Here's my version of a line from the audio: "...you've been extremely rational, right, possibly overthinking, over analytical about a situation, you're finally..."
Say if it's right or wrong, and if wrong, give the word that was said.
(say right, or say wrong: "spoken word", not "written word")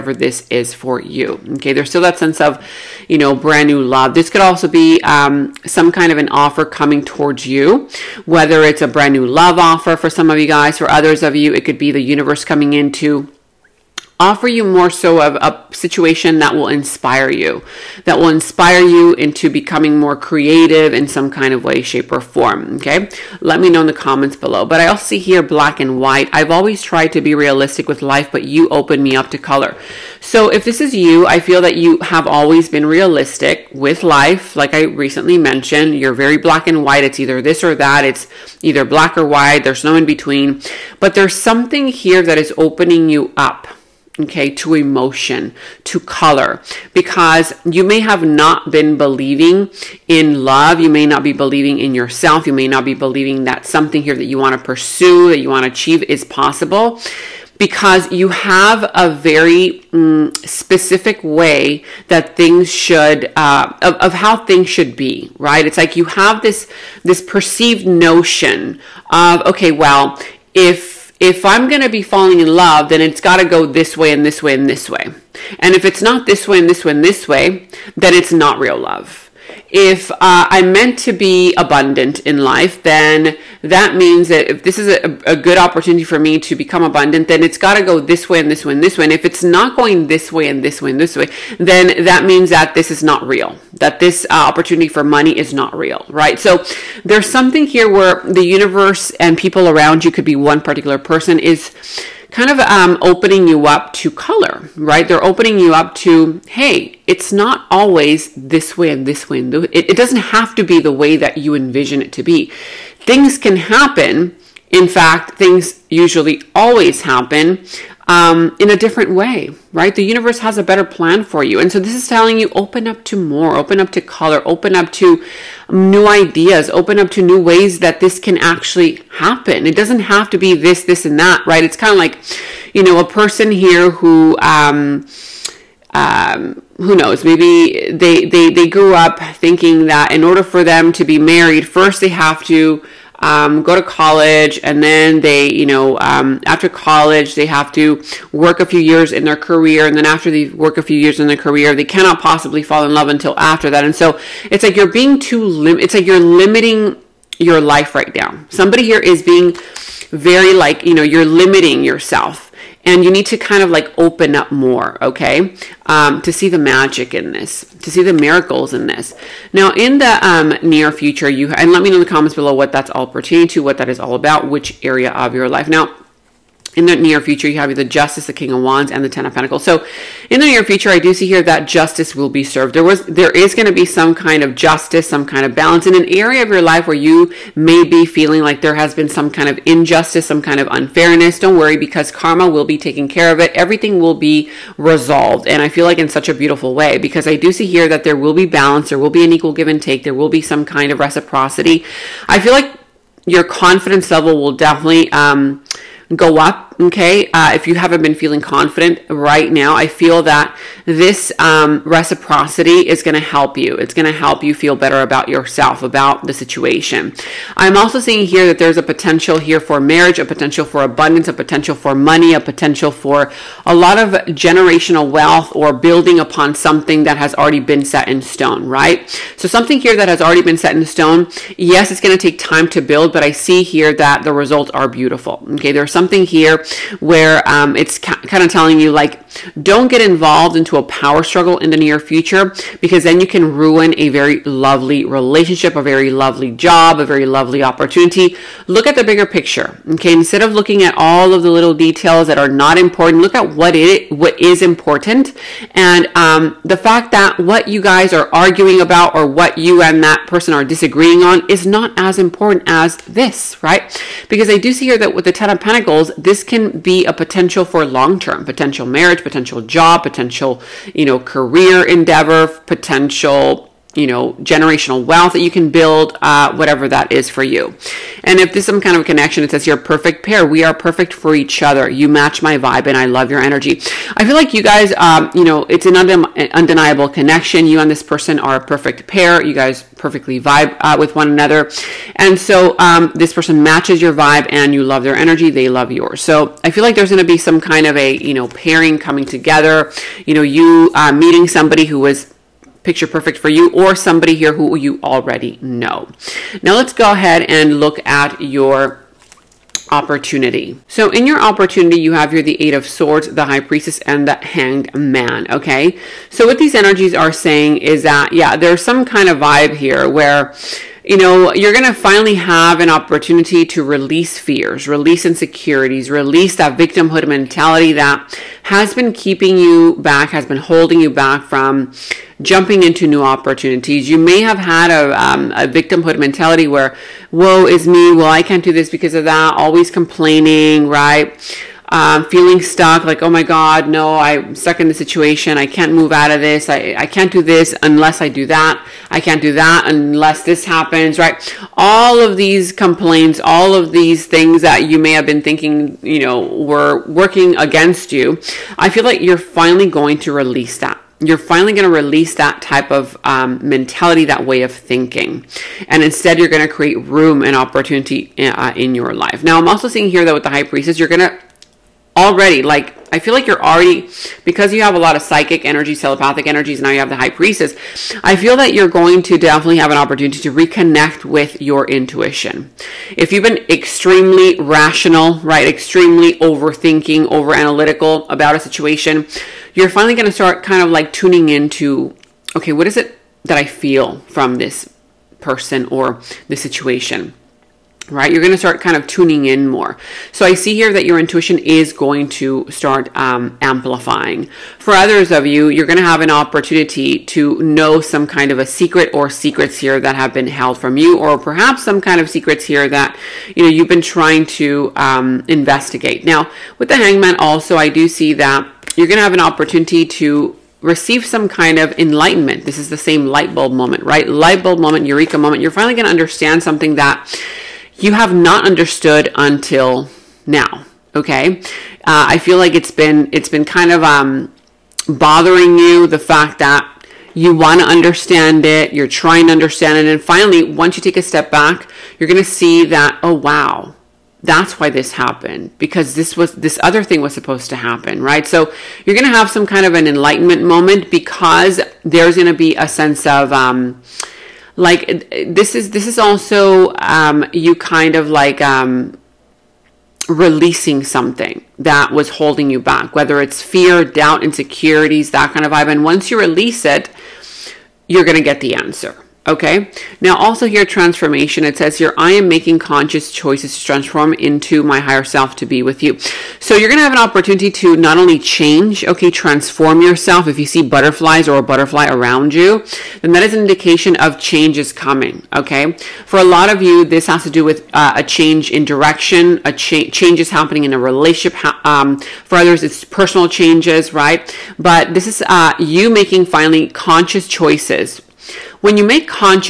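wrong: "extremely", not "possibly".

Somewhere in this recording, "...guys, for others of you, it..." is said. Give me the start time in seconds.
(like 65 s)
10 s.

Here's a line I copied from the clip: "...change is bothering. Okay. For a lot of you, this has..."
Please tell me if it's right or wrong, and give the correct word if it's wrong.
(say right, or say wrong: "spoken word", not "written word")
wrong: "coming", not "bothering".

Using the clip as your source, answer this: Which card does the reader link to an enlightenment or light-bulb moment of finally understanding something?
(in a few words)
Hanged Man.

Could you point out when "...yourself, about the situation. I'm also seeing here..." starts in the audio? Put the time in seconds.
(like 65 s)
215 s.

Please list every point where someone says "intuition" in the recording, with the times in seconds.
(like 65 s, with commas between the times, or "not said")
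381 s, 401 s.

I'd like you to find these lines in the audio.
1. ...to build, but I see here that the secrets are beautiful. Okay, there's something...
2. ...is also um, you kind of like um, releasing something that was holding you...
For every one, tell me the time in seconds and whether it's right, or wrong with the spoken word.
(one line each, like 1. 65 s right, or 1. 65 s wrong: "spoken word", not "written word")
1. 232 s wrong: "results", not "secrets"
2. 456 s right.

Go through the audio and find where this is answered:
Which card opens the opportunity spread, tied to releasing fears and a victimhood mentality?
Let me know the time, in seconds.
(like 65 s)
312 s.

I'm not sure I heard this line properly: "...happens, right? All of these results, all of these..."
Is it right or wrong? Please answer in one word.
wrong.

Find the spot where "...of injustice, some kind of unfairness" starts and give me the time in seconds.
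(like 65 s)
189 s.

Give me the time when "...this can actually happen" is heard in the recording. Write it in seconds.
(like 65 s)
127 s.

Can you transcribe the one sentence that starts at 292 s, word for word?
And so um, this person matches your vibe and you love their energy.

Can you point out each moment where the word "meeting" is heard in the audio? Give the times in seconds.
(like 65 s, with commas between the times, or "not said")
301 s.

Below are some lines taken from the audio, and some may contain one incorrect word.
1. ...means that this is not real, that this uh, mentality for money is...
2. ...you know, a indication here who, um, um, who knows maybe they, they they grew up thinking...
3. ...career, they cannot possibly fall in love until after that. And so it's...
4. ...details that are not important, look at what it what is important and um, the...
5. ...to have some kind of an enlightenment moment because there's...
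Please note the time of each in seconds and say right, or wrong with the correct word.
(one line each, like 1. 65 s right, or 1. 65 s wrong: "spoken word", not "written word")
1. 92 s wrong: "opportunity", not "mentality"
2. 132 s wrong: "person", not "indication"
3. 151 s right
4. 251 s right
5. 449 s right.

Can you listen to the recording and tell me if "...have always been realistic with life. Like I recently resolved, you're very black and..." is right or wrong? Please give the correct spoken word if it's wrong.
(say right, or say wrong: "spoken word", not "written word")
wrong: "mentioned", not "resolved".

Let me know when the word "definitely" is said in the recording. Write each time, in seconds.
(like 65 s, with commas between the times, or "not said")
204 s, 379 s.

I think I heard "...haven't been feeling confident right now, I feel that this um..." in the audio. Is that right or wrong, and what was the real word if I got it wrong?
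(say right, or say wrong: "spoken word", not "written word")
right.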